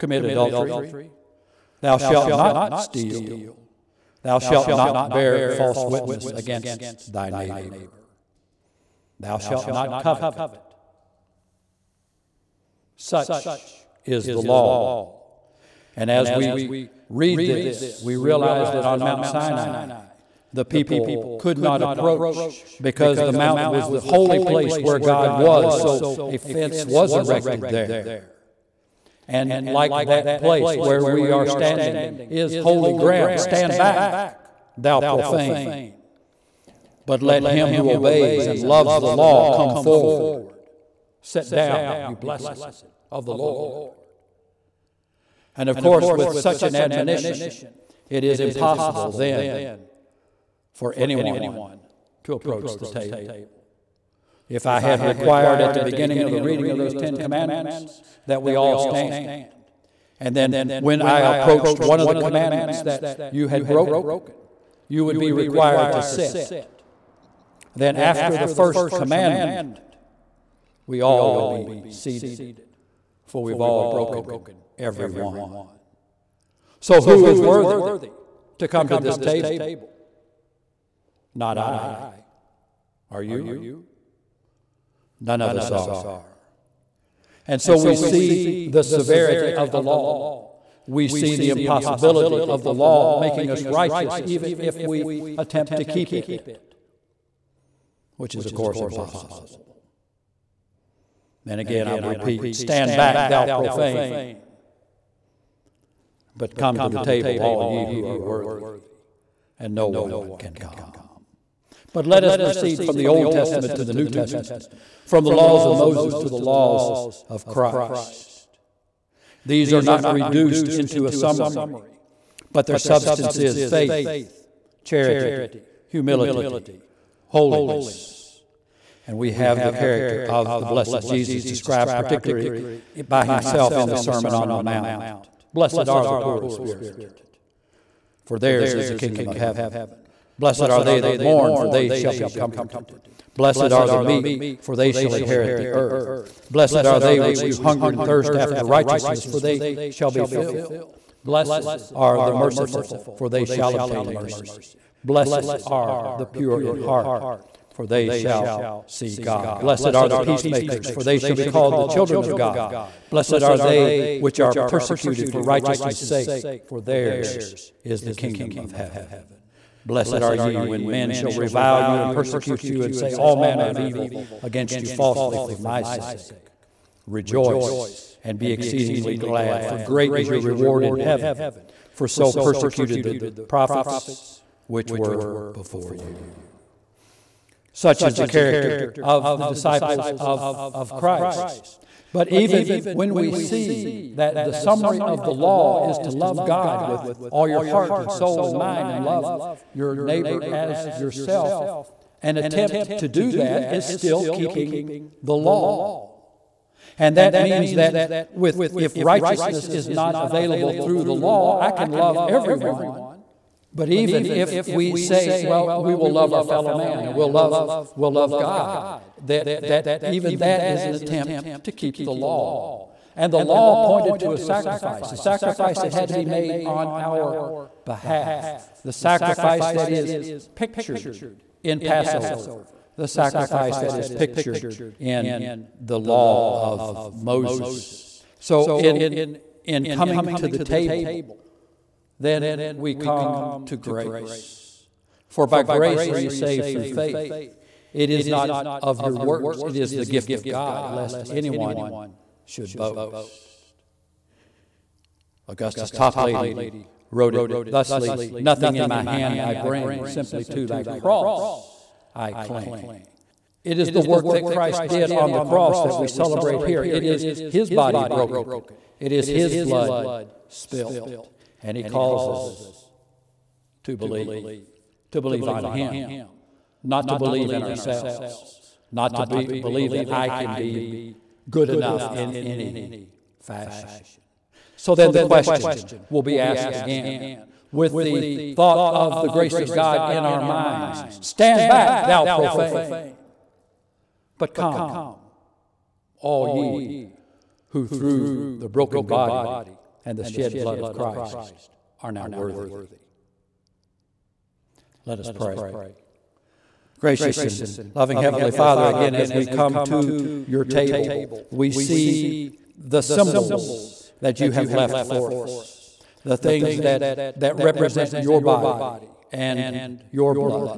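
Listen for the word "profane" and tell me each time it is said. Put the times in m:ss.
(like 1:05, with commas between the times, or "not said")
0:34, 1:43, 4:52.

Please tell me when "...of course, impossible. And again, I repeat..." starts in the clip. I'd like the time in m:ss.
1:38.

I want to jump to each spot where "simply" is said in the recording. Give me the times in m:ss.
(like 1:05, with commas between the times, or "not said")
4:20.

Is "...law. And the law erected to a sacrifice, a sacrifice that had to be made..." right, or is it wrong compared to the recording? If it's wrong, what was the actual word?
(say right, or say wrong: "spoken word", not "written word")
wrong: "pointed", not "erected".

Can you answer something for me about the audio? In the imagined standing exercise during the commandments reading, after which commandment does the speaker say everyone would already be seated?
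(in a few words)
the first.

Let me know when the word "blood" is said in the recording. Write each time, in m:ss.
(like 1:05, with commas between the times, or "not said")
4:29, 5:00.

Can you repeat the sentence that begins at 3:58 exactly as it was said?
So, in, in coming to the table, then we come to grace.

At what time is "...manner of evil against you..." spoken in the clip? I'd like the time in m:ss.
2:53.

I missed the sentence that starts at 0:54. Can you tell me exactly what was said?
If I had required at the beginning of the reading of those Ten Commandments that we all stand.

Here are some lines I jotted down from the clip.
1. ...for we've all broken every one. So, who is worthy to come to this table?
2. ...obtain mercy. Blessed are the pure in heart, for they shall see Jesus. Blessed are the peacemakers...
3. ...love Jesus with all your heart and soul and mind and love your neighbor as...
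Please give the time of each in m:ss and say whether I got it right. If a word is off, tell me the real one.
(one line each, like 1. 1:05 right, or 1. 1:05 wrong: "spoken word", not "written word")
1. 1:13 right
2. 2:33 wrong: "God", not "Jesus"
3. 3:16 wrong: "God", not "Jesus".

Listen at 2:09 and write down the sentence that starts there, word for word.
And we have the character of the blessed Jesus described particularly by himself in the Sermon on the Mount.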